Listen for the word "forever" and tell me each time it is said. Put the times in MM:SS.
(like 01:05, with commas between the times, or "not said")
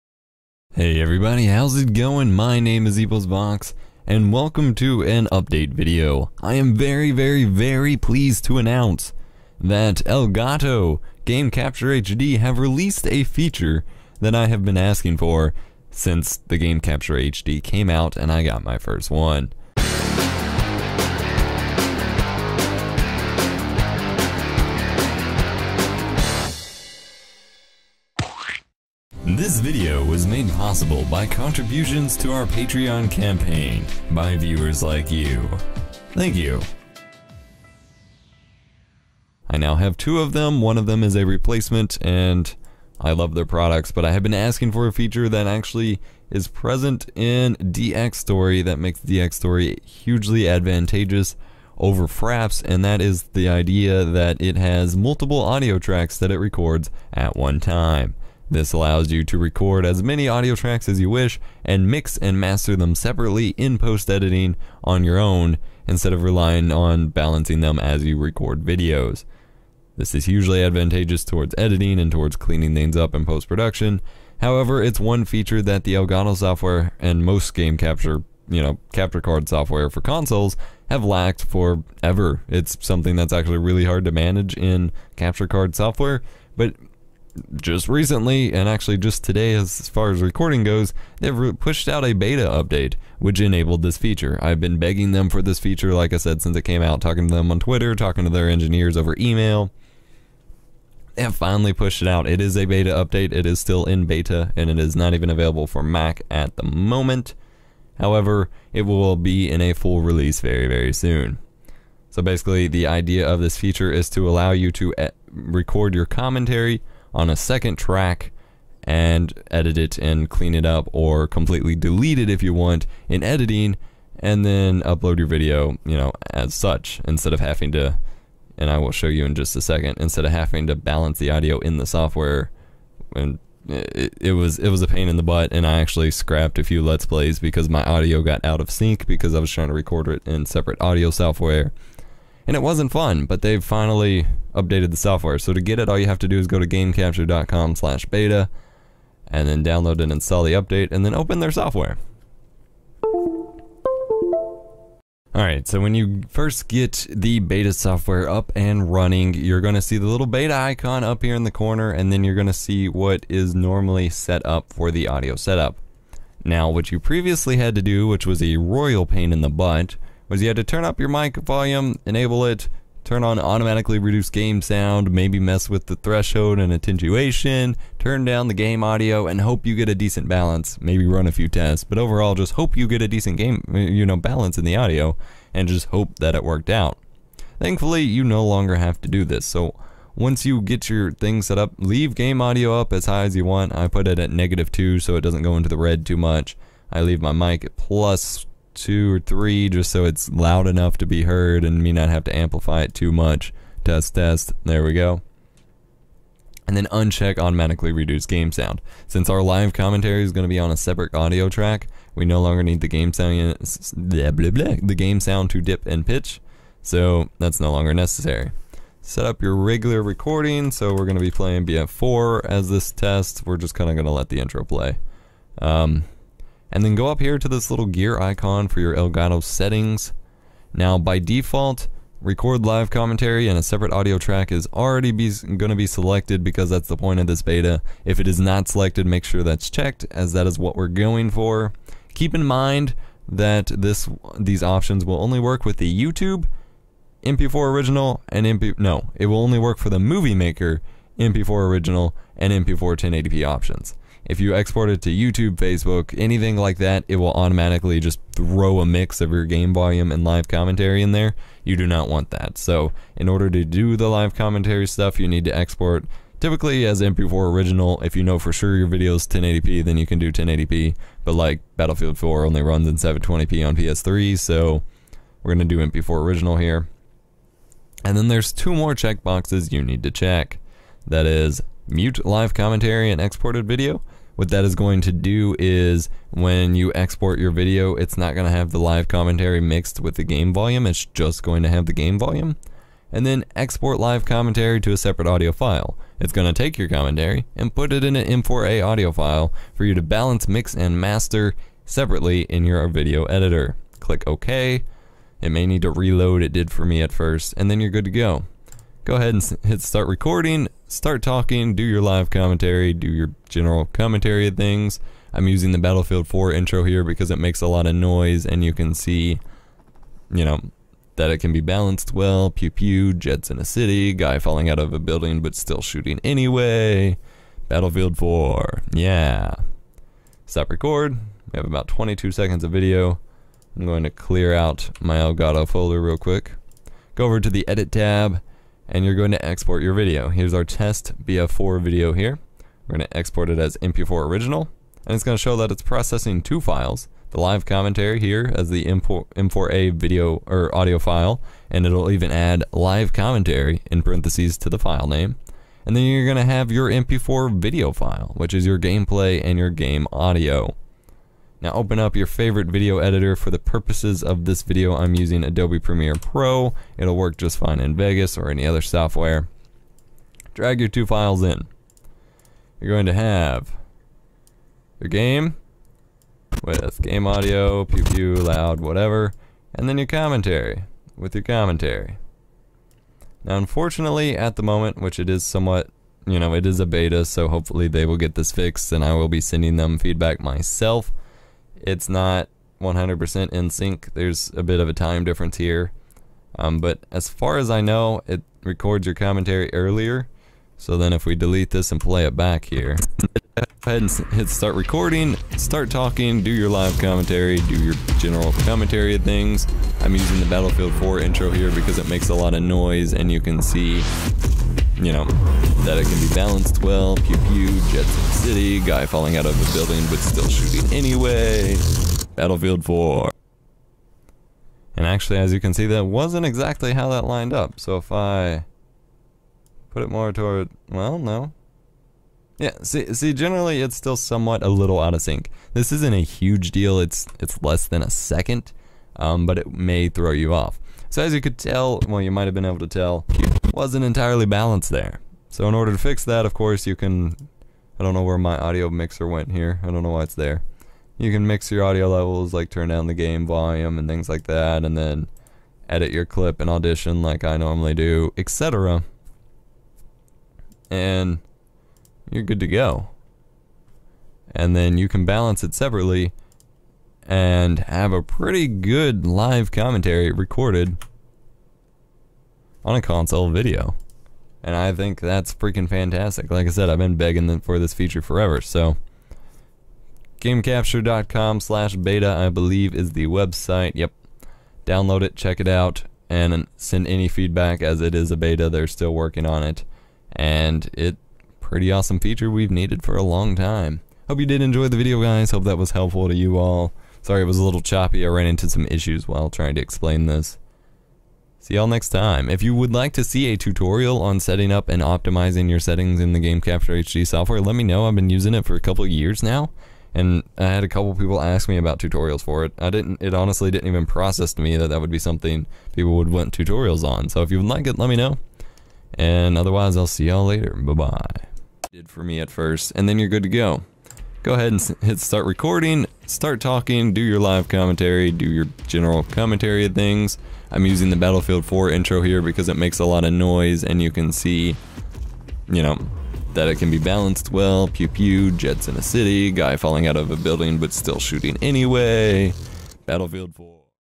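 01:21, 07:58.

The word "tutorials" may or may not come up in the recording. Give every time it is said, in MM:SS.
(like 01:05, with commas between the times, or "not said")
08:23, 08:31, 08:36.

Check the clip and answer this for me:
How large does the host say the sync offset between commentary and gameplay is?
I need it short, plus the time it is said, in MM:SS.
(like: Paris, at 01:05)
less than a second, at 07:17.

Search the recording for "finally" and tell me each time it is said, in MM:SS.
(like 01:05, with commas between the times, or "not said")
01:41, 02:23.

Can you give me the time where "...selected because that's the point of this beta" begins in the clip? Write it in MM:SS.
03:55.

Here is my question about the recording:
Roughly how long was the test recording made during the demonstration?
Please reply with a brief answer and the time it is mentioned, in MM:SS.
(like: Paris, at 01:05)
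22 seconds, at 05:31.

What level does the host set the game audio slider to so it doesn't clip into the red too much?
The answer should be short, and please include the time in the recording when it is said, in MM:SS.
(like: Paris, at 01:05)
-2, at 03:14.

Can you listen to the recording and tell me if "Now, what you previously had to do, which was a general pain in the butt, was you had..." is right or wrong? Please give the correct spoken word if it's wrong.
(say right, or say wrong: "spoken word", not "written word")
wrong: "royal", not "general".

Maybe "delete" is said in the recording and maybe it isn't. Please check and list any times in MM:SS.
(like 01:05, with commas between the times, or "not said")
02:01, 06:41.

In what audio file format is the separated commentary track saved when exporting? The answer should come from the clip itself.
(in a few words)
M4A.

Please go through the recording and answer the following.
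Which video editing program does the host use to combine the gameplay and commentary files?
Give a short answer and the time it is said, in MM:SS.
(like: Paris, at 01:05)
Adobe Premiere Pro, at 06:05.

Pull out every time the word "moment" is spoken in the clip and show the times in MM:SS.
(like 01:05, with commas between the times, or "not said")
01:46, 06:24.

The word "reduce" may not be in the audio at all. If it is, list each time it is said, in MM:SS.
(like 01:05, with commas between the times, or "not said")
02:53, 03:27.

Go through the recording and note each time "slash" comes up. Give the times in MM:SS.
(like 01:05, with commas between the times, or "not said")
02:27, 08:01.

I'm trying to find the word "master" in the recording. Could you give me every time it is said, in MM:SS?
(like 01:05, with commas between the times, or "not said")
01:02, 05:00.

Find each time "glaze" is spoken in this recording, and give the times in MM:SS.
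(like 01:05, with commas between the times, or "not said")
not said.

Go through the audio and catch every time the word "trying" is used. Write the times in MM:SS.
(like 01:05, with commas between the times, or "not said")
02:19, 08:19.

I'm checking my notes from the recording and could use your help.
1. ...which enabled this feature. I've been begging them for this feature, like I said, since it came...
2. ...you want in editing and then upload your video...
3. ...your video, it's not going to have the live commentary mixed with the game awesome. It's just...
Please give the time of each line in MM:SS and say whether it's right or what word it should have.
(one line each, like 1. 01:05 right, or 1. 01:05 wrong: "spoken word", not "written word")
1. 01:33 right
2. 02:02 right
3. 04:47 wrong: "volume", not "awesome".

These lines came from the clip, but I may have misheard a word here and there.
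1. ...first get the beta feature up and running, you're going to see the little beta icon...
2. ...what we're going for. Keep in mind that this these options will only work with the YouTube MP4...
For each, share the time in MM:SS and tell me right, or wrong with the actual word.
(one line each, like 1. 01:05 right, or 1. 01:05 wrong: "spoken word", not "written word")
1. 02:36 wrong: "software", not "feature"
2. 04:00 right.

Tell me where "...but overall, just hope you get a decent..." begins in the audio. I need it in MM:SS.
03:01.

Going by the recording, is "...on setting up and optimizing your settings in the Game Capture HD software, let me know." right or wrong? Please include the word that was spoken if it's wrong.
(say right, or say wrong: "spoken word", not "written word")
right.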